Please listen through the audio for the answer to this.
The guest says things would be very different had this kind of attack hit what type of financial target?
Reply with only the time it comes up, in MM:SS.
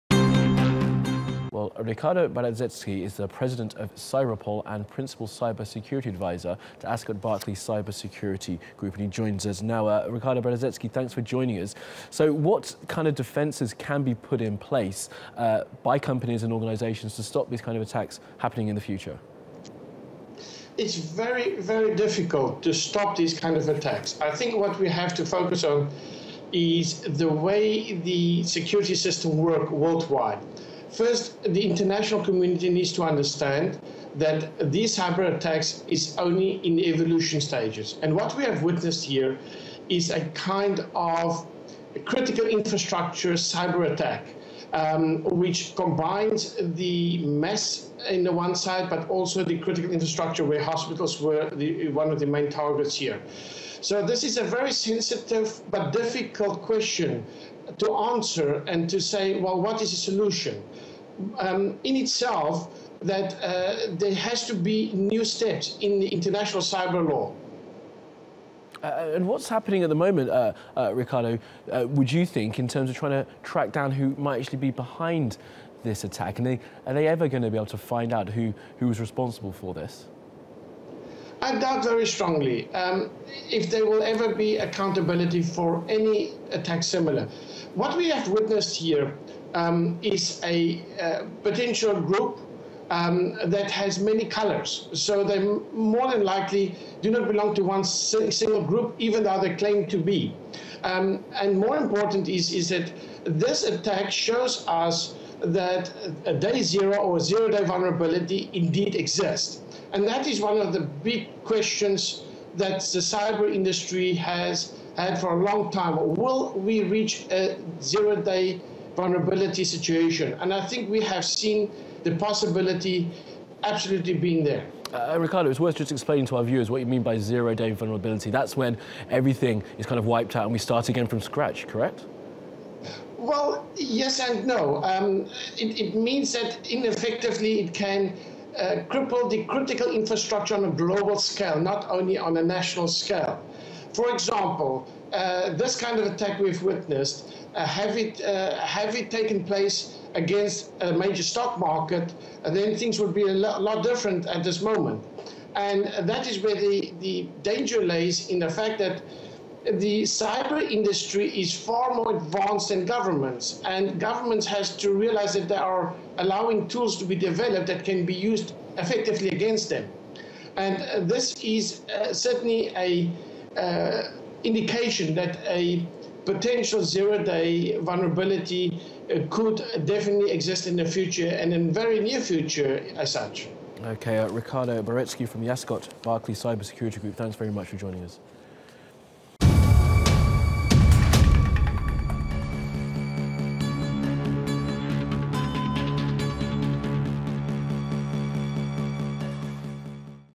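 02:30.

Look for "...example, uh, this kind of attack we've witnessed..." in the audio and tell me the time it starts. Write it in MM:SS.
02:24.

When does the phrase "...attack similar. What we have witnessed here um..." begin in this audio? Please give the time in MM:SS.
01:26.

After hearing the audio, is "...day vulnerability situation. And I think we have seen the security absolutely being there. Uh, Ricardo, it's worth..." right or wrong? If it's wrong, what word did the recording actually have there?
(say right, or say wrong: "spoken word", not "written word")
wrong: "possibility", not "security".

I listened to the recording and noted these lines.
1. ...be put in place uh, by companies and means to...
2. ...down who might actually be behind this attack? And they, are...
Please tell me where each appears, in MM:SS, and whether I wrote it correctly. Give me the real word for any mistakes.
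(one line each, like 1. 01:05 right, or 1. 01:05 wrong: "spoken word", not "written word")
1. 00:14 wrong: "organisations", not "means"
2. 01:13 right.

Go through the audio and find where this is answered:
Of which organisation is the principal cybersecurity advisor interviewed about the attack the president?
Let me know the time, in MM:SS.
00:03.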